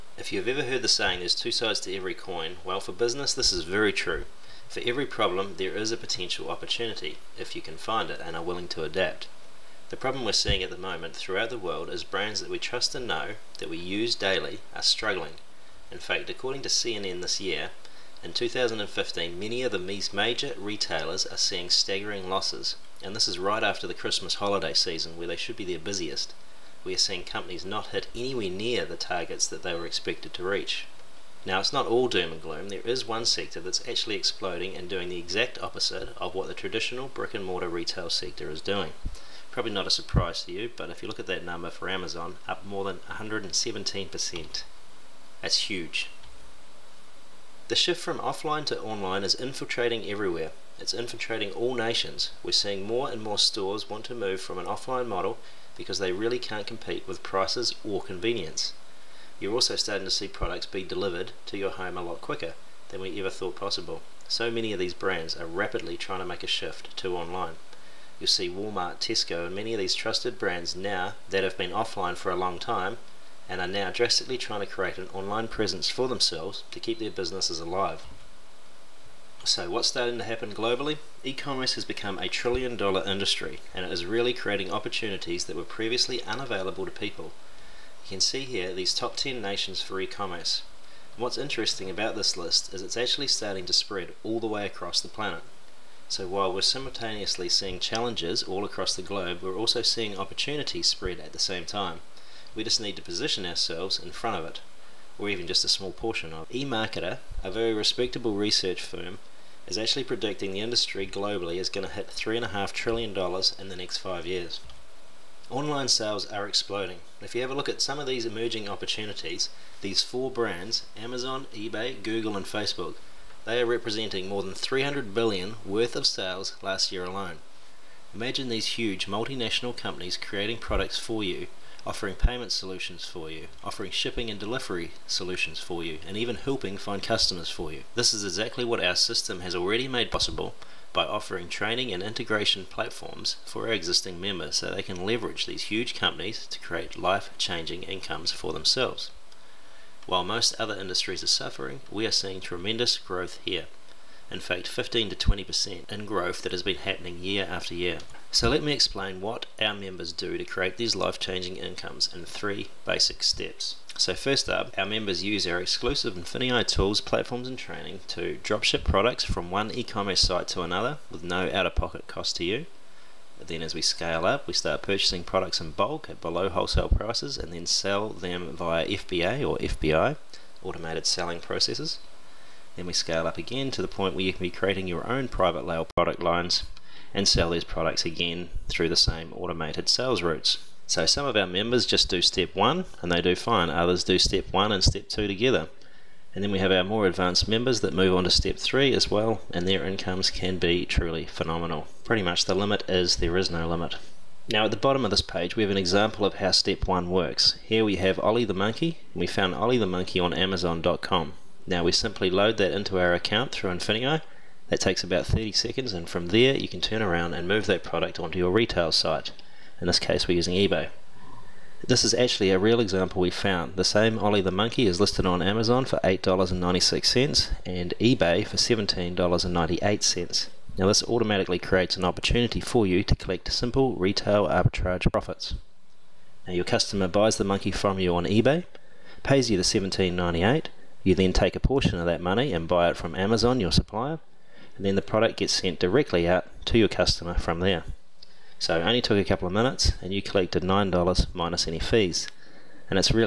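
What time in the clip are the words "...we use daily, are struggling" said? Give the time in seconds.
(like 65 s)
13 s.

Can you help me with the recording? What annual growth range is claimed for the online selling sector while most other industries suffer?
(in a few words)
15 to 20%.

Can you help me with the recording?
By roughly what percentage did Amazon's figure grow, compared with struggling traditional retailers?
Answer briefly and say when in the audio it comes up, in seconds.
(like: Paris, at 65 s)
117%, at 43 s.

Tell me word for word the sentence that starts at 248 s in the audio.
So it only took a couple of minutes and you collected $9 minus any fees.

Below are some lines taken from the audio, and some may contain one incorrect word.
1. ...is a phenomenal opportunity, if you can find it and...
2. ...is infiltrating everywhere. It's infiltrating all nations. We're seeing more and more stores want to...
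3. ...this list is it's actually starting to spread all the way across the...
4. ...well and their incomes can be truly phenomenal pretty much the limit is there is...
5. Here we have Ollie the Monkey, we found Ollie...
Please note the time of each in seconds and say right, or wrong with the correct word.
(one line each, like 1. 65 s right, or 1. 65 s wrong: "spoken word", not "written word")
1. 5 s wrong: "potential", not "phenomenal"
2. 49 s right
3. 92 s right
4. 199 s right
5. 207 s right.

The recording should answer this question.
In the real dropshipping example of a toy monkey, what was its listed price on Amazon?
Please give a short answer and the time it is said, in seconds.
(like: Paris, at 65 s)
$8.96, at 226 s.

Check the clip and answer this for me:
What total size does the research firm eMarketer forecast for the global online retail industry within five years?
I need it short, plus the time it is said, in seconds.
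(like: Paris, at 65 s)
$3.5 trillion, at 112 s.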